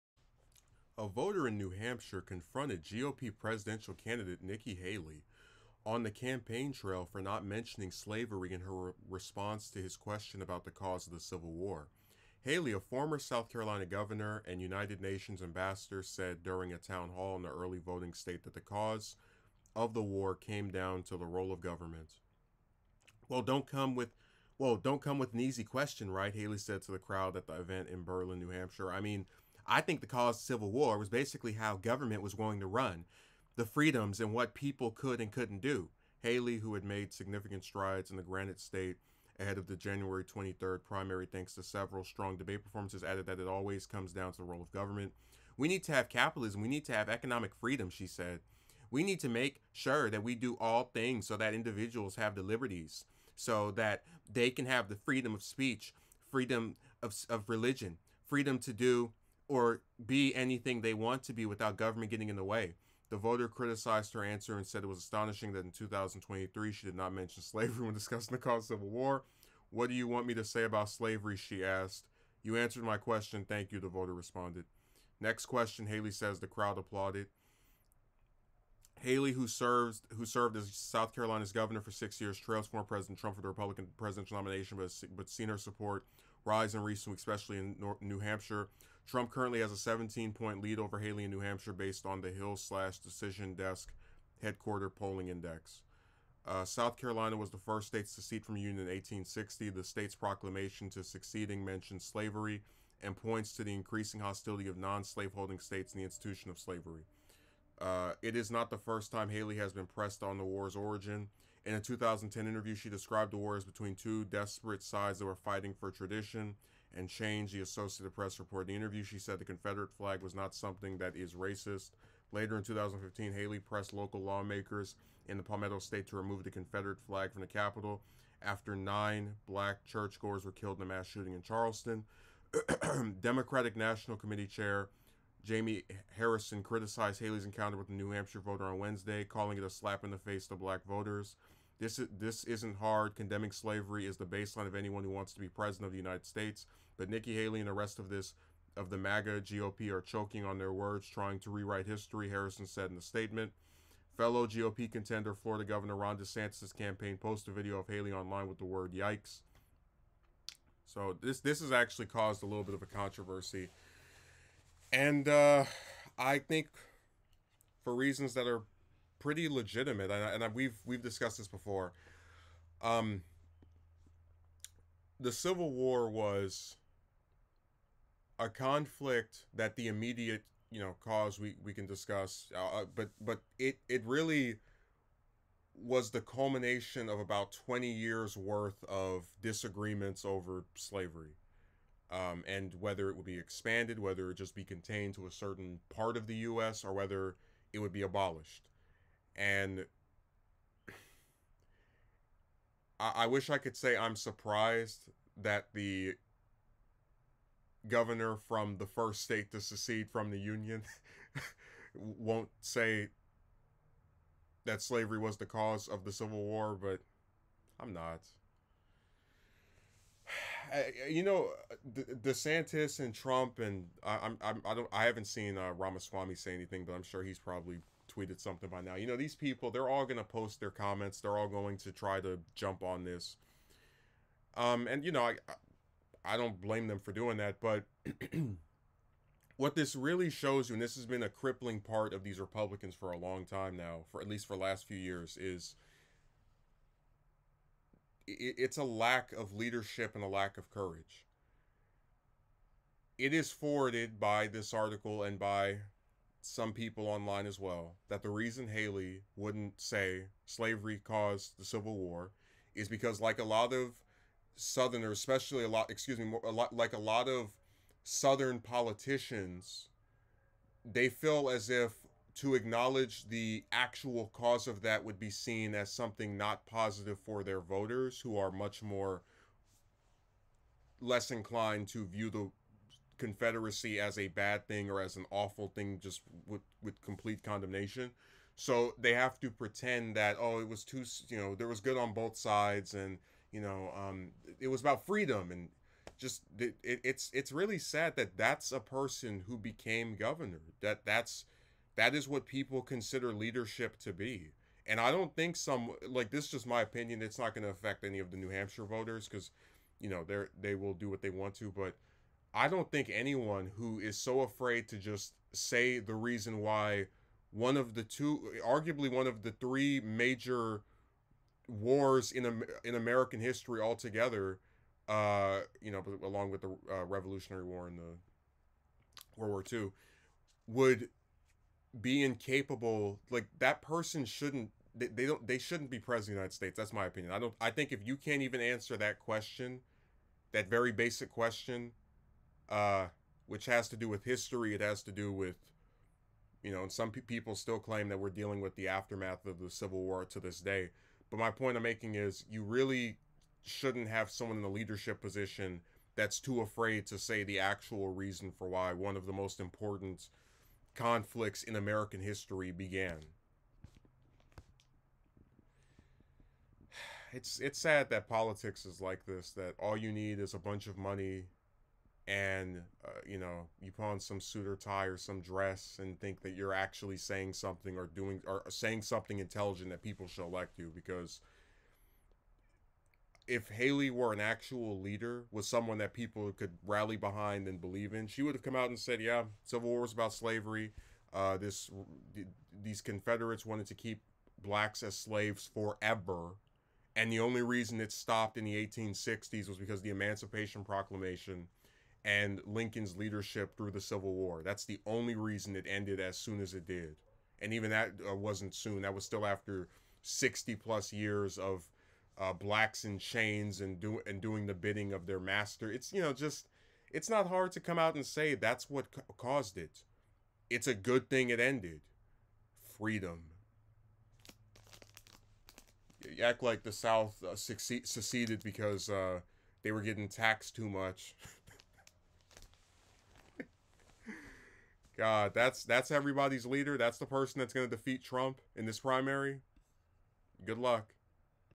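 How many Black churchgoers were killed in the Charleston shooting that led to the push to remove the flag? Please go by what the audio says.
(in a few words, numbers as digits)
9.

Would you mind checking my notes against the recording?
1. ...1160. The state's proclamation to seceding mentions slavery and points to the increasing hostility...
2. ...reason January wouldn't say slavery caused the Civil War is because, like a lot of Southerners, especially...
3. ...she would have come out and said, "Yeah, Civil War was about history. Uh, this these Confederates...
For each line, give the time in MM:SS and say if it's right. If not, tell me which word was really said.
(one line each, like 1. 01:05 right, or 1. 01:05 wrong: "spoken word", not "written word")
1. 01:38 wrong: "1860", not "1160"
2. 04:18 wrong: "Haley", not "January"
3. 06:28 wrong: "slavery", not "history".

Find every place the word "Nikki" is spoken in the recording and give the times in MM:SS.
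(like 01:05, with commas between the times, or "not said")
00:04, 02:27.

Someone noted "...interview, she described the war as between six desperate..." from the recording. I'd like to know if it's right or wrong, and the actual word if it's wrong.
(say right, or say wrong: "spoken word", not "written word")
wrong: "two", not "six".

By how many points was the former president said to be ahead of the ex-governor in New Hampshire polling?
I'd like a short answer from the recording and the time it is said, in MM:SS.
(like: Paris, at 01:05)
17, at 01:29.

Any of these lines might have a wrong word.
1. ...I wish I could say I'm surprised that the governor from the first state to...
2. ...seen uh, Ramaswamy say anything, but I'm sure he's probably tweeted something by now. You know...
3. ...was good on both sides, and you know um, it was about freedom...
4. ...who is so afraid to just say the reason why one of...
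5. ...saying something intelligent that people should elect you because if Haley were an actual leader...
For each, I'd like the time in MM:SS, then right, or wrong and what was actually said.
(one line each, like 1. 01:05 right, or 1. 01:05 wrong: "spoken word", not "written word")
1. 03:23 right
2. 03:45 right
3. 04:51 right
4. 05:13 right
5. 06:18 right.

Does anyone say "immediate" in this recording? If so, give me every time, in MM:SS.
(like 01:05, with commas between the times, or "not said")
02:59.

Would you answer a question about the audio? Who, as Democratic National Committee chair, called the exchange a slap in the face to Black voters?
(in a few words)
Jamie Harrison.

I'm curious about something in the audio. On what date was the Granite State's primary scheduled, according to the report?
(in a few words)
January 23rd.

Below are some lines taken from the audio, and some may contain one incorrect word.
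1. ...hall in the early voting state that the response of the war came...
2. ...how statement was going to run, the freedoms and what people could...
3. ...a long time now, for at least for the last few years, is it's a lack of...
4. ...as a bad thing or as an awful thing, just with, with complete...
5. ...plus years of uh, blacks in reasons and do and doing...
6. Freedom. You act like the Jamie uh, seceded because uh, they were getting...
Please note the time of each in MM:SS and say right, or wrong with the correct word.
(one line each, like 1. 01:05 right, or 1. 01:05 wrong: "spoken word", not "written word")
1. 00:17 wrong: "cause", not "response"
2. 00:31 wrong: "government", not "statement"
3. 04:03 right
4. 04:43 right
5. 06:50 wrong: "chains", not "reasons"
6. 07:02 wrong: "South", not "Jamie".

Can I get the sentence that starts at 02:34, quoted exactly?
Fellow GOP contender Florida Governor Ron DeSantis' campaign posted a video of Haley online with the word yikes.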